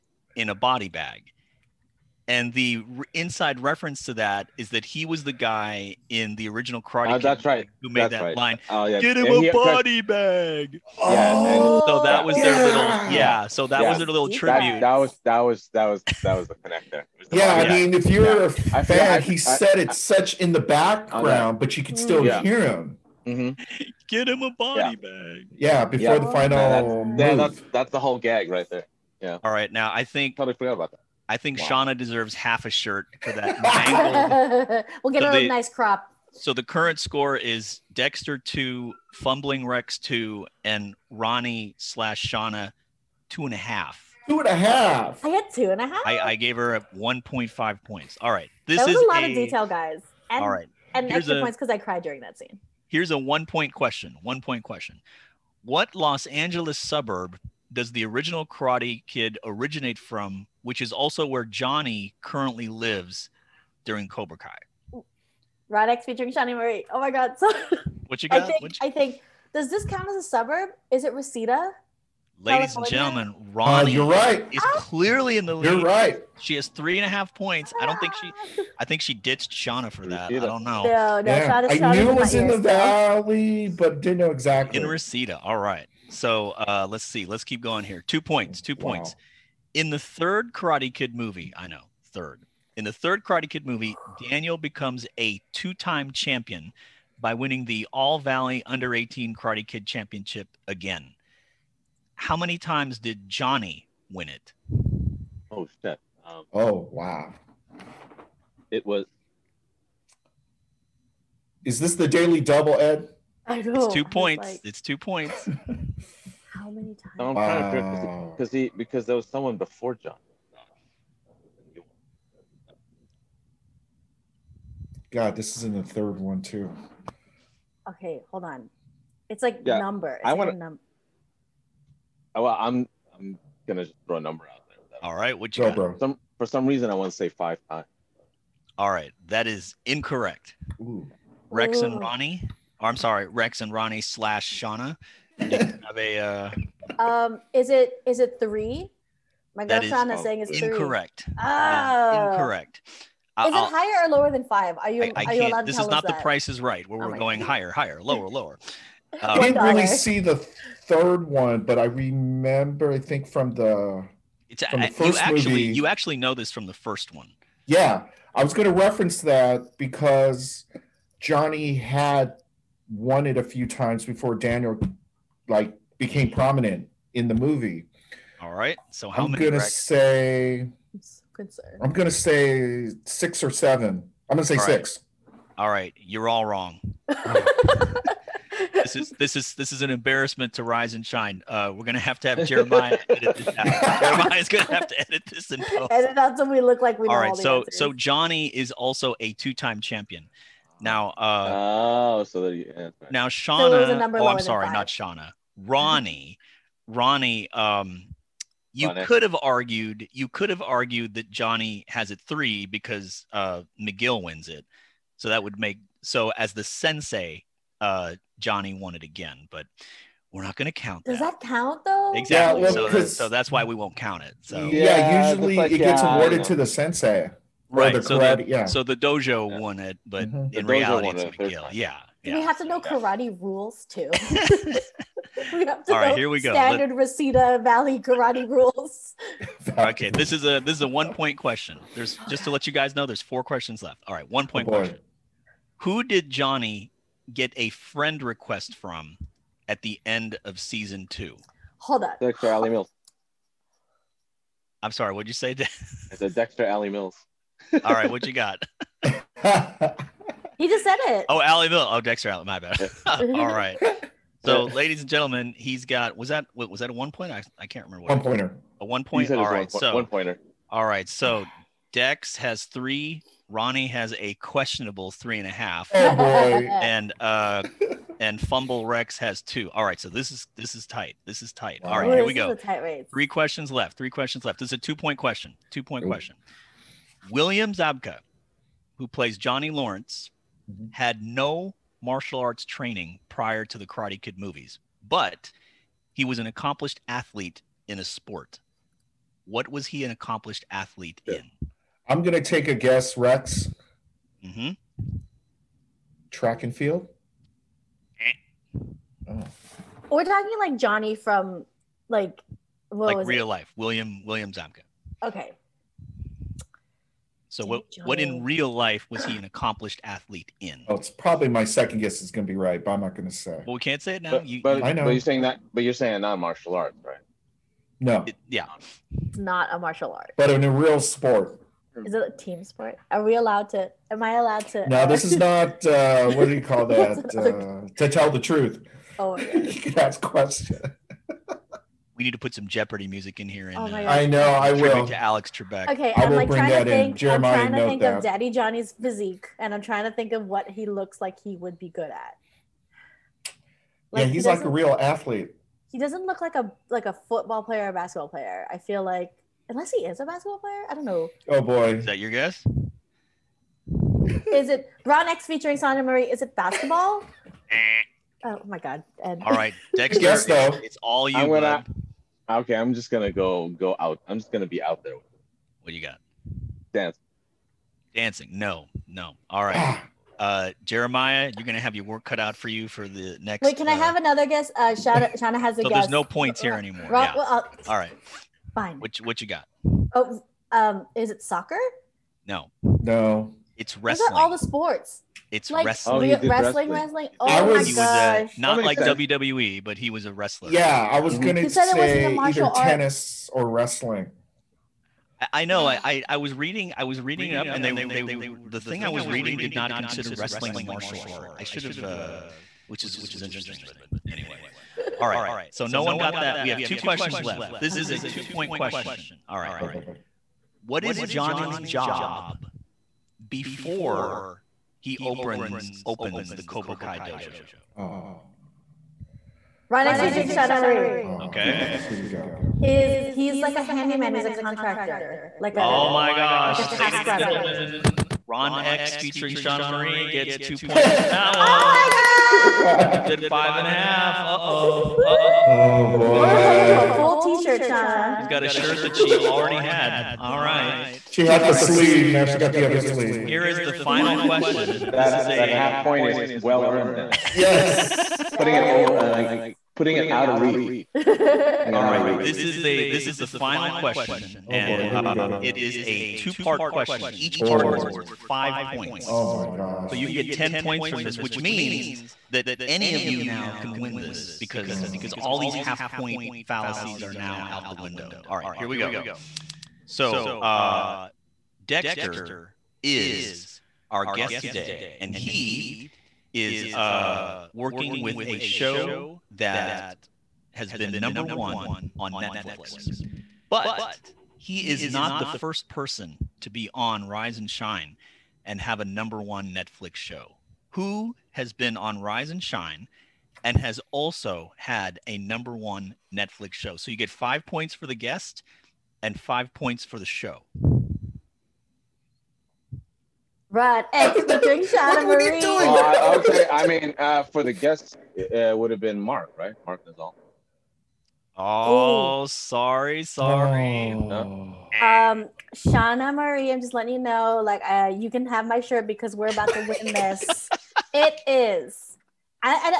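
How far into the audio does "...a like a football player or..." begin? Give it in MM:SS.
05:56.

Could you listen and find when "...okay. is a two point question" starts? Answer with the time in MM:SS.
06:57.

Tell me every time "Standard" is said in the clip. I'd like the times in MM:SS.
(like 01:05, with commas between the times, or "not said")
03:56.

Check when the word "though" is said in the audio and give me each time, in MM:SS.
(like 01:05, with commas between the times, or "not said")
03:41, 06:10.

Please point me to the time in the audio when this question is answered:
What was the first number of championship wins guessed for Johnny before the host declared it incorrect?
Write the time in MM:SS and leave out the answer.
02:17.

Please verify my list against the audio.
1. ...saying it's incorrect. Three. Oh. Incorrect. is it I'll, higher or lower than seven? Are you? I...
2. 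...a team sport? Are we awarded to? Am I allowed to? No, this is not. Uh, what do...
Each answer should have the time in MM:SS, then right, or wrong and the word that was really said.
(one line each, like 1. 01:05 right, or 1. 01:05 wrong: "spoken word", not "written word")
1. 02:30 wrong: "five", not "seven"
2. 05:32 wrong: "allowed", not "awarded".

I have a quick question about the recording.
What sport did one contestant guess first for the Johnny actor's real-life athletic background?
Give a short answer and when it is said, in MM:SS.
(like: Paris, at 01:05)
Track and field, at 05:06.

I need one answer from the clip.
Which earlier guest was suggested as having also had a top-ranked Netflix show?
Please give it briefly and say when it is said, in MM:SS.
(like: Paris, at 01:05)
Mark Nizal, at 08:39.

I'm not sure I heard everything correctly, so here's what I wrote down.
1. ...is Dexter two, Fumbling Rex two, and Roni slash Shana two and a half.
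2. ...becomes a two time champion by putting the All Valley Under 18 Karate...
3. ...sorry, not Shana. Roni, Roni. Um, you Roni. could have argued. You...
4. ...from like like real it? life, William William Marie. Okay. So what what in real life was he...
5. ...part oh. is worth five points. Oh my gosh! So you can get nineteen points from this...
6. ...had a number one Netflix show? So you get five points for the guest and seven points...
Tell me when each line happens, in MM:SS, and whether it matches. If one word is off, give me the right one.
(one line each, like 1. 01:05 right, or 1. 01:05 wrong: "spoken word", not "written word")
1. 00:37 right
2. 01:34 wrong: "winning", not "putting"
3. 03:24 right
4. 05:11 wrong: "Zabka", not "Marie"
5. 07:47 wrong: "ten", not "nineteen"
6. 08:24 wrong: "five", not "seven".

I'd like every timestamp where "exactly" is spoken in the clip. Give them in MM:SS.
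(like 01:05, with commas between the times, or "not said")
01:24, 03:42.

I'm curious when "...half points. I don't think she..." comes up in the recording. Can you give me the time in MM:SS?
01:17.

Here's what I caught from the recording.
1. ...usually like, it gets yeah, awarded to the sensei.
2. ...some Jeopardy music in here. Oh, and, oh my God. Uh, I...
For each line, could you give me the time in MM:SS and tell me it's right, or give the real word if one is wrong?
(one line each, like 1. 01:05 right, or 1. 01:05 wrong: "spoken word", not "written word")
1. 03:45 right
2. 05:42 right.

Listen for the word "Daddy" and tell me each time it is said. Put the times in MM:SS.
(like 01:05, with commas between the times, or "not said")
05:48.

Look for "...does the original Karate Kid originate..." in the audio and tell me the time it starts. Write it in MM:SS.
00:57.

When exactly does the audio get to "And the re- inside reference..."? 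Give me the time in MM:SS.
00:02.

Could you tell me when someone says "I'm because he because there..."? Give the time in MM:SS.
01:57.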